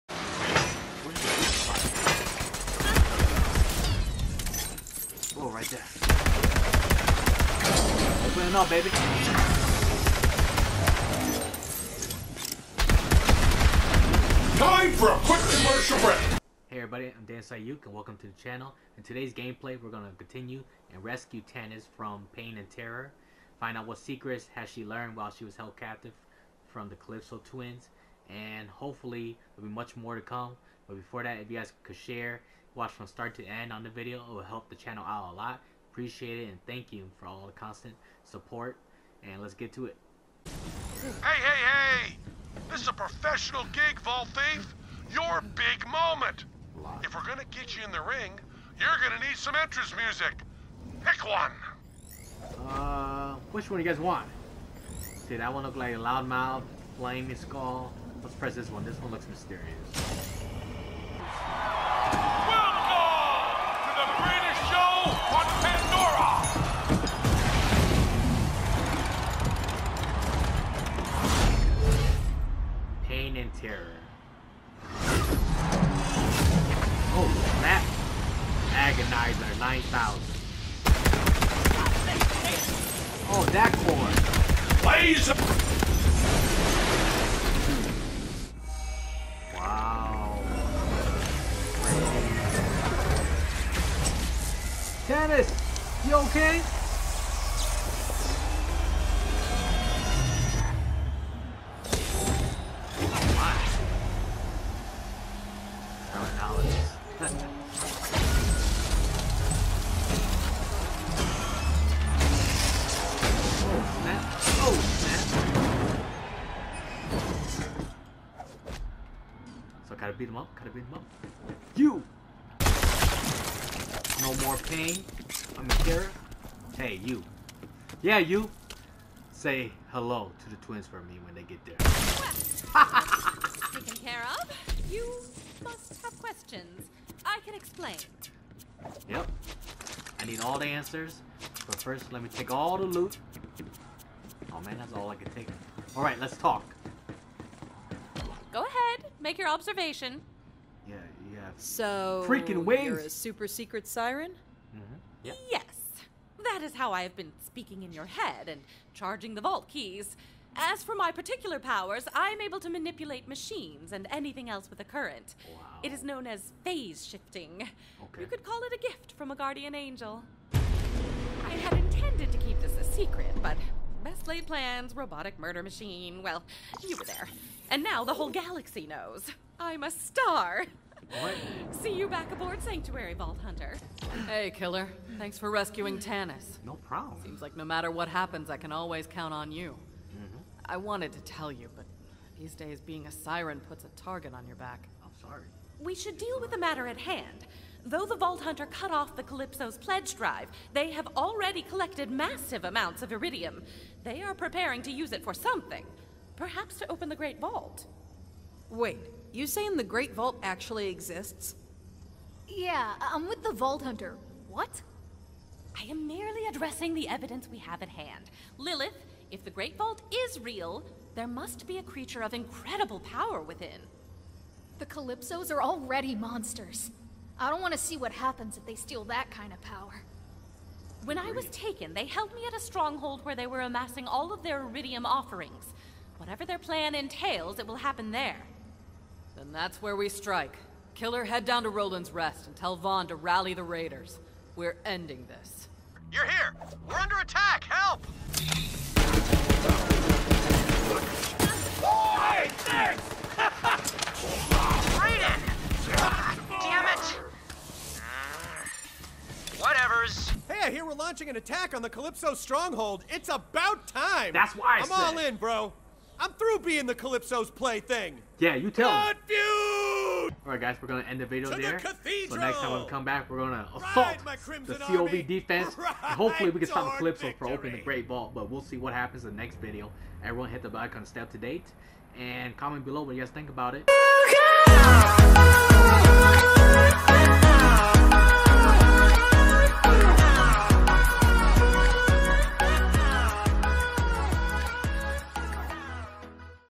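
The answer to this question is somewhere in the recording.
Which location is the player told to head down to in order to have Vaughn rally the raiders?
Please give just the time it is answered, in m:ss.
4:01.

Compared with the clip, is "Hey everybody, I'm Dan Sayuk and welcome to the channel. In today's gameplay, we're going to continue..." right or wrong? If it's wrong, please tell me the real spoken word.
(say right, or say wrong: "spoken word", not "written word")
right.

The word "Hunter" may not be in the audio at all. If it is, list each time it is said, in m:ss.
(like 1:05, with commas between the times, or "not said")
3:03, 3:18, 3:33.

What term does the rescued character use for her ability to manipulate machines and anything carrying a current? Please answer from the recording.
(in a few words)
Phase shifting.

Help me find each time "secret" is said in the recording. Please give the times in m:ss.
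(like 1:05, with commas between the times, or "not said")
0:23, 2:33, 2:52.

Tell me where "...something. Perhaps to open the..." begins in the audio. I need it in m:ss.
3:25.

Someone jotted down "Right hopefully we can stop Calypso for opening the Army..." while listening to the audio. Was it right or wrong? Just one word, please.
wrong.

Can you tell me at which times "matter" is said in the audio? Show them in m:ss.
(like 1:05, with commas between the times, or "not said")
3:07, 3:16.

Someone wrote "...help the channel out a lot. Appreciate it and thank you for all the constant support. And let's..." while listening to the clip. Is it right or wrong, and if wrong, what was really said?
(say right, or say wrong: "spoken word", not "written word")
right.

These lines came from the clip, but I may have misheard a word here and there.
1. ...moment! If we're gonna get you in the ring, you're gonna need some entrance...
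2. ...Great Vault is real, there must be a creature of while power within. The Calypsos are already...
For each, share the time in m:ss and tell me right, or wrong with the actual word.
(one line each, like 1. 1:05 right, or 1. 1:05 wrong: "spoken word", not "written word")
1. 0:45 right
2. 3:39 wrong: "incredible", not "while".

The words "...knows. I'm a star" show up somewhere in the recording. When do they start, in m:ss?
2:58.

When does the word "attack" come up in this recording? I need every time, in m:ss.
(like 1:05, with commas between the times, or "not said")
4:07, 4:21.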